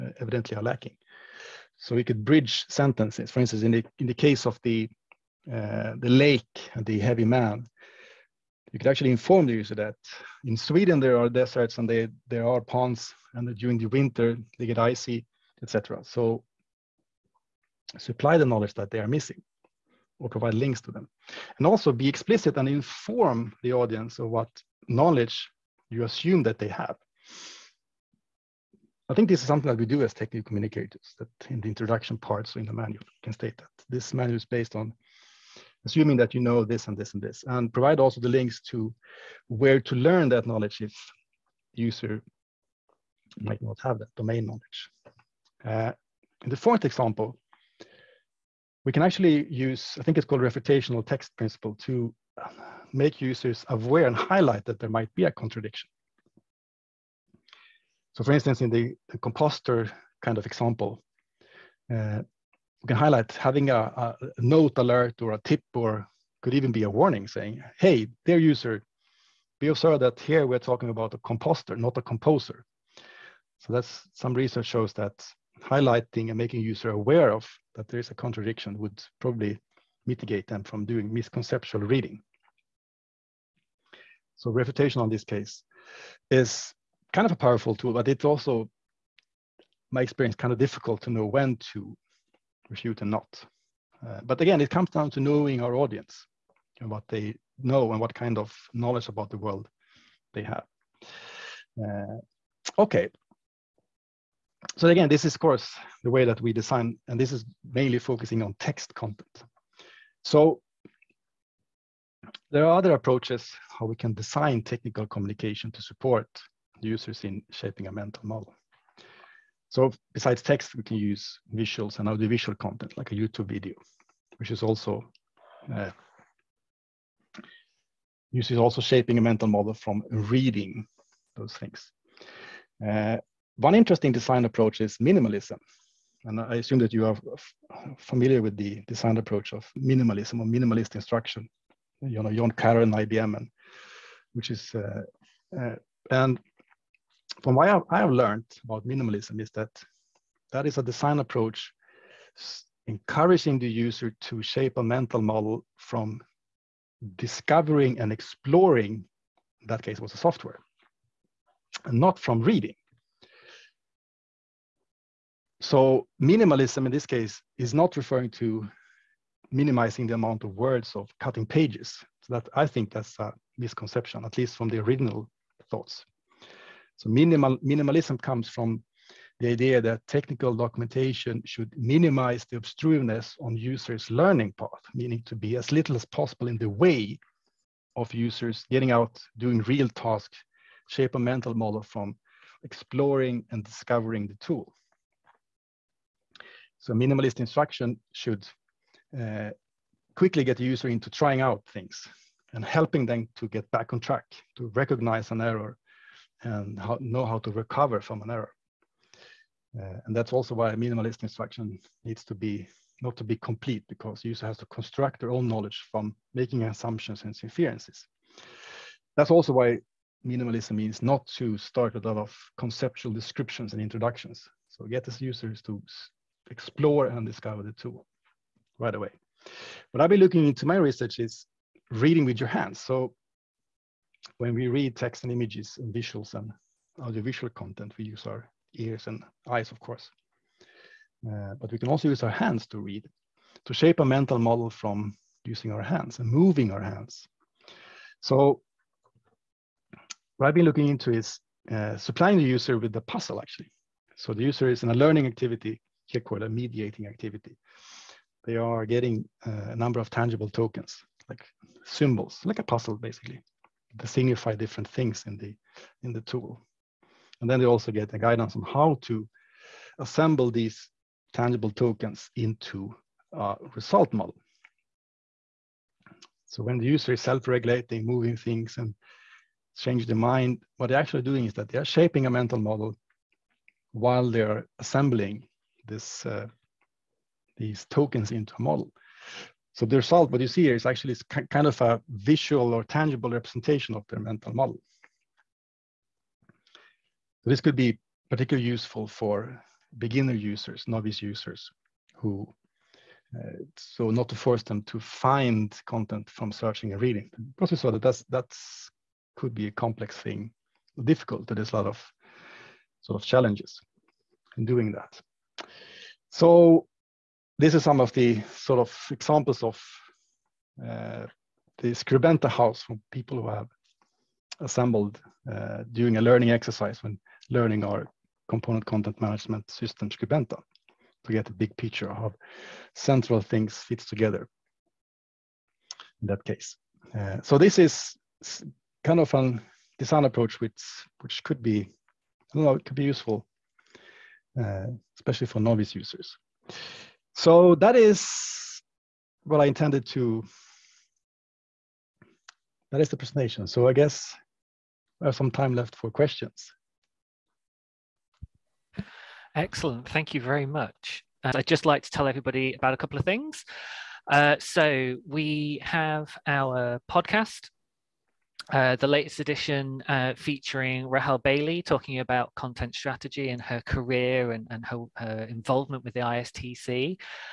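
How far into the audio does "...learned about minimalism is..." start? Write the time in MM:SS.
02:28.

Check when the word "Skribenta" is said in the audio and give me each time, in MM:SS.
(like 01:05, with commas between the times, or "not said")
05:21, 05:30.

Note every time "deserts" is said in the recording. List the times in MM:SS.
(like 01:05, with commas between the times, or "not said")
00:11.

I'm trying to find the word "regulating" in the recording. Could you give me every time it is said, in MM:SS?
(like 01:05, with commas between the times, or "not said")
04:37.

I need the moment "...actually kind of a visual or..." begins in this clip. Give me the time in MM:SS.
04:50.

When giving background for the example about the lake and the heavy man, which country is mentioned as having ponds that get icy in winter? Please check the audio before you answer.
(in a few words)
Sweden.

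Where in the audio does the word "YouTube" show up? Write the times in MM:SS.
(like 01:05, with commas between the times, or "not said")
02:03.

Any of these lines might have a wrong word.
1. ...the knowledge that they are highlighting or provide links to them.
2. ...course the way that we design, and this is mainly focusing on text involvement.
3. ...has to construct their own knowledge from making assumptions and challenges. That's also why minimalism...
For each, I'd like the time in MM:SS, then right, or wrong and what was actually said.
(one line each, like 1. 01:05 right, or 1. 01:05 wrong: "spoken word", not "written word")
1. 00:18 wrong: "missing", not "highlighting"
2. 01:45 wrong: "content", not "involvement"
3. 03:34 wrong: "inferences", not "challenges".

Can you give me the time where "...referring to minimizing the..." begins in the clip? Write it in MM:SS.
02:47.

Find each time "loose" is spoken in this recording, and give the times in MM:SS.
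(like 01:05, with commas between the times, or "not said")
not said.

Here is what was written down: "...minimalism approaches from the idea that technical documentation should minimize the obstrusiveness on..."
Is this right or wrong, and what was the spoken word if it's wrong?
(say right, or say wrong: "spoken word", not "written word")
wrong: "comes", not "approaches".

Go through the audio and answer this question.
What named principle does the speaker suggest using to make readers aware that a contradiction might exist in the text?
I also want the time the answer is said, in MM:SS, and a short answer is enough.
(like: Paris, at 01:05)
Refutational text principle, at 00:50.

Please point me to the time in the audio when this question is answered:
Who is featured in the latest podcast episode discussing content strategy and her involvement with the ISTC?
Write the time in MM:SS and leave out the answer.
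06:11.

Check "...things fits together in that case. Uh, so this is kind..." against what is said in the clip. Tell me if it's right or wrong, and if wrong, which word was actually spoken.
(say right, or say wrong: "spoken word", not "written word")
right.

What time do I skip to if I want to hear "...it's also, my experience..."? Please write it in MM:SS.
01:28.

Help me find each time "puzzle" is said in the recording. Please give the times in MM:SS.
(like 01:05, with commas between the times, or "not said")
04:13, 04:22.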